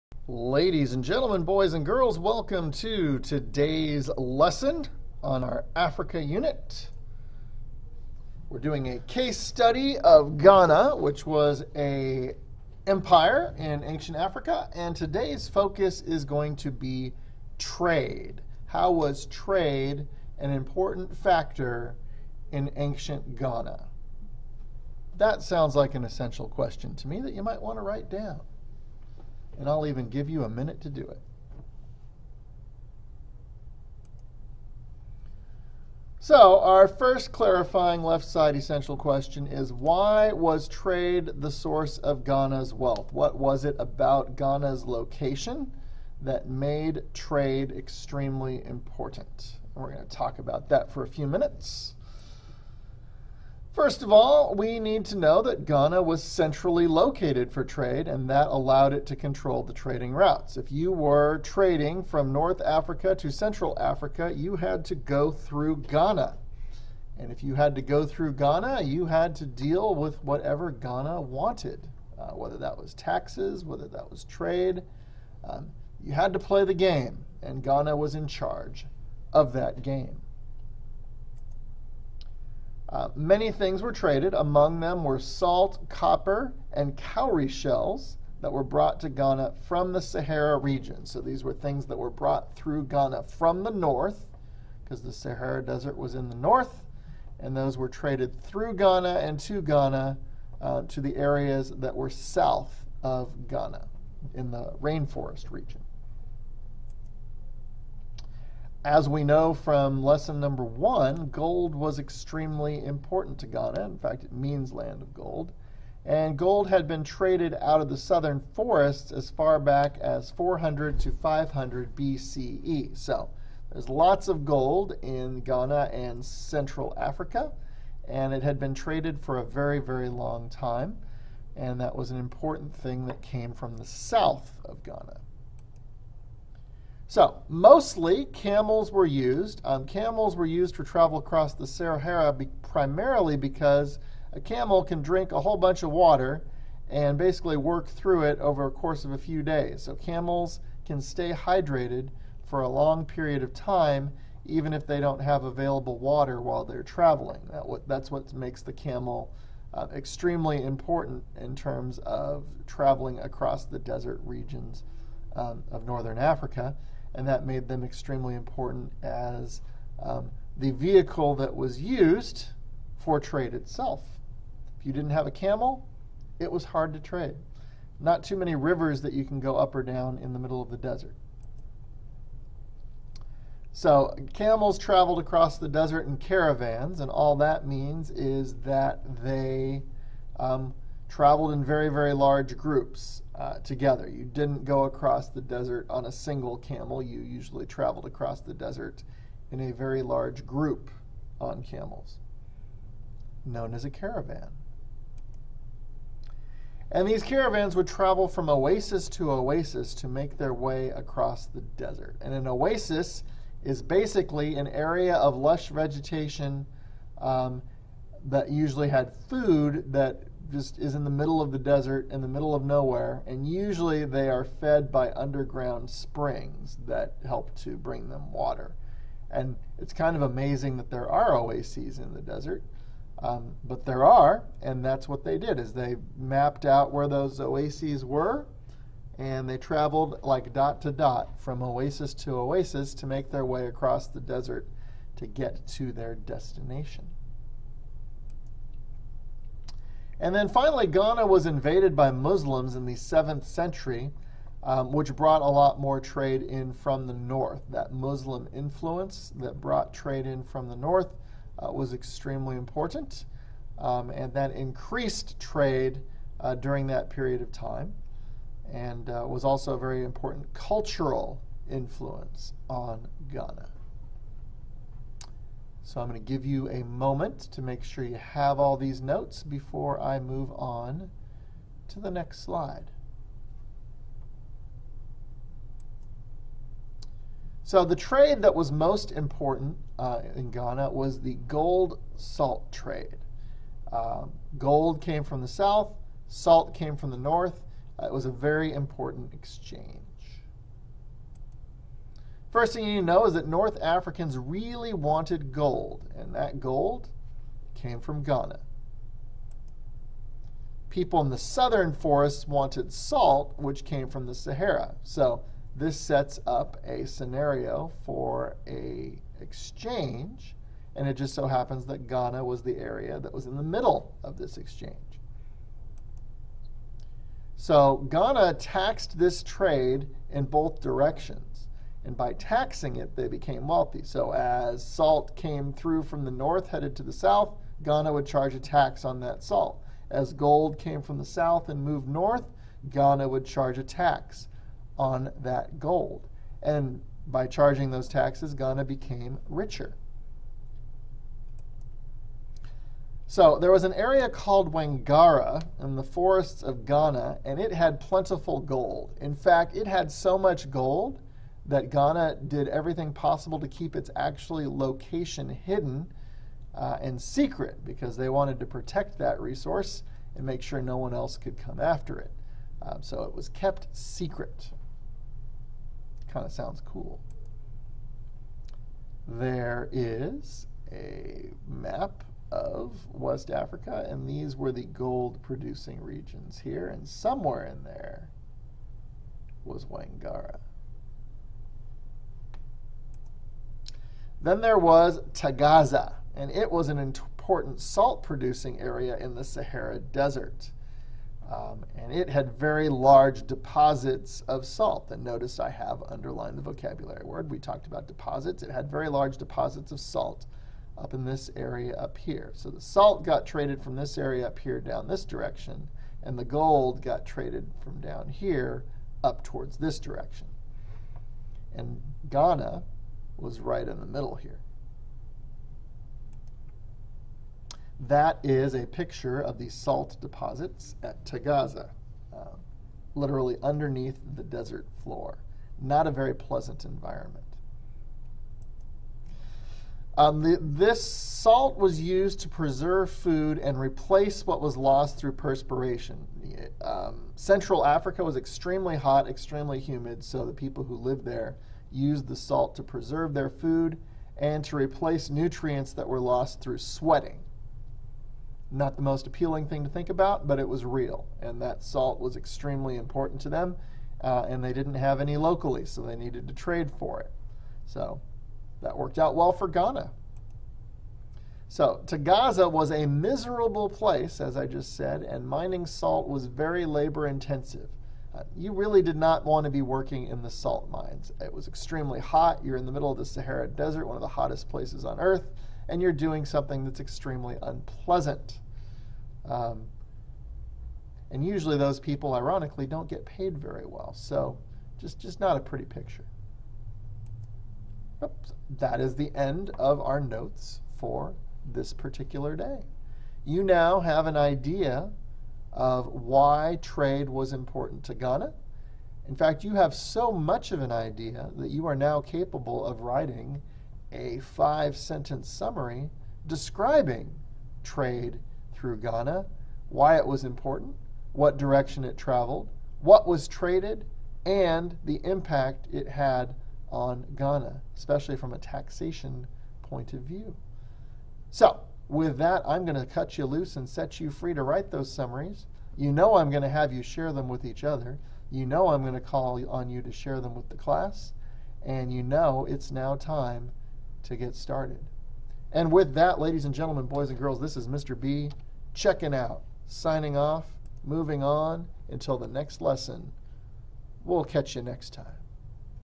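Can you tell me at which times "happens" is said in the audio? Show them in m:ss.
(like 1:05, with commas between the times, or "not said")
5:21.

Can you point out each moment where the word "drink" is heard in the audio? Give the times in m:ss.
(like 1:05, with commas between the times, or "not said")
2:25.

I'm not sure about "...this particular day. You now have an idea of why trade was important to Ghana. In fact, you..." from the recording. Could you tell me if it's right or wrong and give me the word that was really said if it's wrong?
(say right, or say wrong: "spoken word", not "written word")
right.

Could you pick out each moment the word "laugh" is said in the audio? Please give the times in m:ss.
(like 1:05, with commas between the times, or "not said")
not said.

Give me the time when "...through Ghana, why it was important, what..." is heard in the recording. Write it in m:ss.
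8:38.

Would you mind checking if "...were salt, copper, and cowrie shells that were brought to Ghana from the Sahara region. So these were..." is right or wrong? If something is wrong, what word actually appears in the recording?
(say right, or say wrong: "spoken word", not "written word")
right.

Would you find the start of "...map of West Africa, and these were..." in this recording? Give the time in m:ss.
6:21.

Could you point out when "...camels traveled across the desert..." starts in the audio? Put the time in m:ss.
3:04.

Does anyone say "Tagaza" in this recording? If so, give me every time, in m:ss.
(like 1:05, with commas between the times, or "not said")
6:35, 7:11.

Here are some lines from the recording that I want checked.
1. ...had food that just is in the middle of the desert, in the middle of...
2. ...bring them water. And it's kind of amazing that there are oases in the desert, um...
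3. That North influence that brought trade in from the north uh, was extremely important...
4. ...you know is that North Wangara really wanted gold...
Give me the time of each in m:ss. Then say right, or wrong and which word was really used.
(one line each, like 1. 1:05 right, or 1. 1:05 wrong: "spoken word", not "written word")
1. 3:38 right
2. 3:47 right
3. 4:17 wrong: "Muslim", not "North"
4. 5:02 wrong: "Africans", not "Wangara".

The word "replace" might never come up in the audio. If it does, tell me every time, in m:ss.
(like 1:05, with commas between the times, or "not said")
7:23, 7:34.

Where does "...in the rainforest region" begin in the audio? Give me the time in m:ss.
1:44.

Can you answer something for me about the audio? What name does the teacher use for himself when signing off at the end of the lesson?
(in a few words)
Mr. B.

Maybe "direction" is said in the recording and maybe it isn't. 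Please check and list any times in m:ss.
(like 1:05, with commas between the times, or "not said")
5:30, 6:55, 6:59, 8:41.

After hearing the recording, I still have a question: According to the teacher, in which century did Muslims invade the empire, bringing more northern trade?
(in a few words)
7th century.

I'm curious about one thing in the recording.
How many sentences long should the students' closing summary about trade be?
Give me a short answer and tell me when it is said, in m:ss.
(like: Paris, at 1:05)
5, at 8:34.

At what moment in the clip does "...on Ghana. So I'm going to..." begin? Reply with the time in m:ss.
4:32.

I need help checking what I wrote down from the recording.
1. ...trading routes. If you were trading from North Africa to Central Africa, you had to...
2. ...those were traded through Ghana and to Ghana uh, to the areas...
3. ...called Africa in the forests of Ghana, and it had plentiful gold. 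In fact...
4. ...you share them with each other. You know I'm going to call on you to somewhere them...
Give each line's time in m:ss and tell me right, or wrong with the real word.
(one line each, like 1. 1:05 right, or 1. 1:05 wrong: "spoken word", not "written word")
1. 0:59 right
2. 1:37 right
3. 5:54 wrong: "Wangara", not "Africa"
4. 8:56 wrong: "share", not "somewhere".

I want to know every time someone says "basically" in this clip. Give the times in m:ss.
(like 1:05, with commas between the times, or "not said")
2:27, 3:33.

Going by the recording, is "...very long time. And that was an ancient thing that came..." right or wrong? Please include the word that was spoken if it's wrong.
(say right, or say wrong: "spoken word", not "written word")
wrong: "important", not "ancient".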